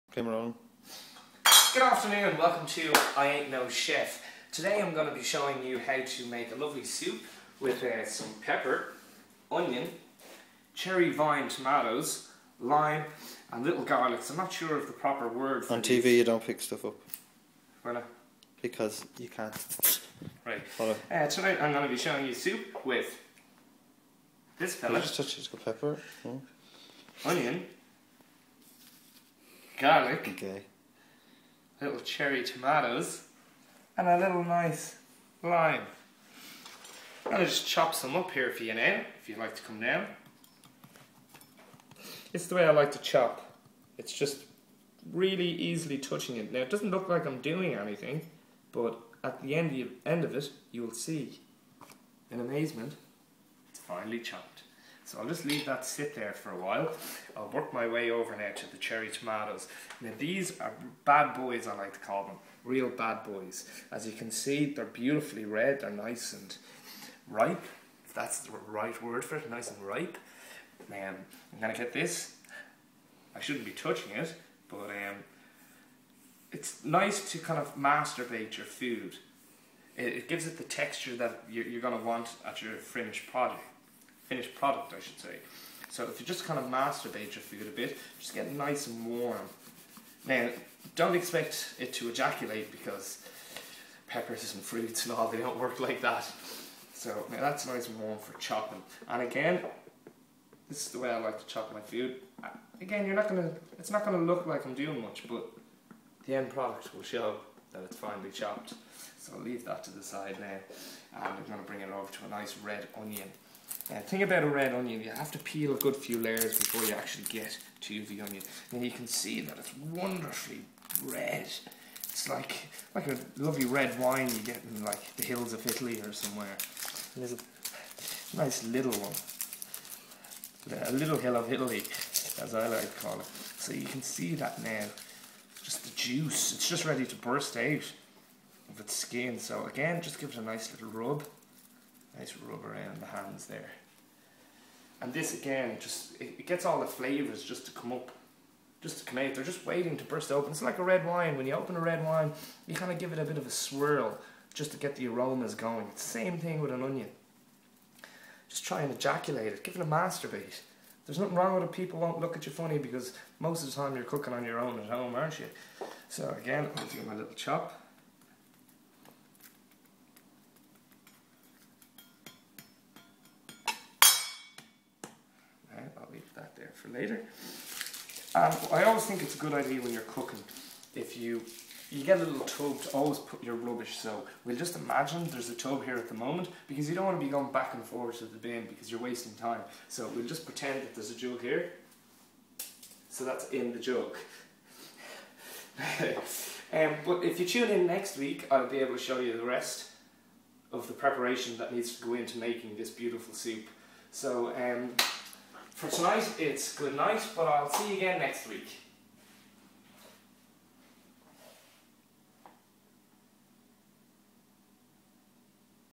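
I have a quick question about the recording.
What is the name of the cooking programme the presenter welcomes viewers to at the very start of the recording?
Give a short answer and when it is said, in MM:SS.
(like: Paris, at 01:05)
I Ain't No Chef, at 00:03.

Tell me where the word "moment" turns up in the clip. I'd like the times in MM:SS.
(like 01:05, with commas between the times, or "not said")
03:06.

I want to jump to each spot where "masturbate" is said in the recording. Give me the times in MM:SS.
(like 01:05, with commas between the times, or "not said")
01:17, 01:26, 02:39.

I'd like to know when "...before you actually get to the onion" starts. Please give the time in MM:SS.
01:56.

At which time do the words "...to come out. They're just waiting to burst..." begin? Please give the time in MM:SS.
02:28.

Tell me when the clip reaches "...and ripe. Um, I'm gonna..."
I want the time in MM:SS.
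01:09.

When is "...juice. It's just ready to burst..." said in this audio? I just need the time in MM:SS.
02:15.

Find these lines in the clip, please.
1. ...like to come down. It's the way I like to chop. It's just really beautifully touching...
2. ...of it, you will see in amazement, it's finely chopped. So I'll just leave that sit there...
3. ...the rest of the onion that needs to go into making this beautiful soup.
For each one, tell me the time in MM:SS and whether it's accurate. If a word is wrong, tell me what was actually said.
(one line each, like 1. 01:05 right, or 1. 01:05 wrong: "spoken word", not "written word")
1. 00:39 wrong: "easily", not "beautifully"
2. 00:50 right
3. 03:19 wrong: "preparation", not "onion".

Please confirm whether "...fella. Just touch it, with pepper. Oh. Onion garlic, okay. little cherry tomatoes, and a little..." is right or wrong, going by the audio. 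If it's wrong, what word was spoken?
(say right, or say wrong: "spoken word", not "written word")
right.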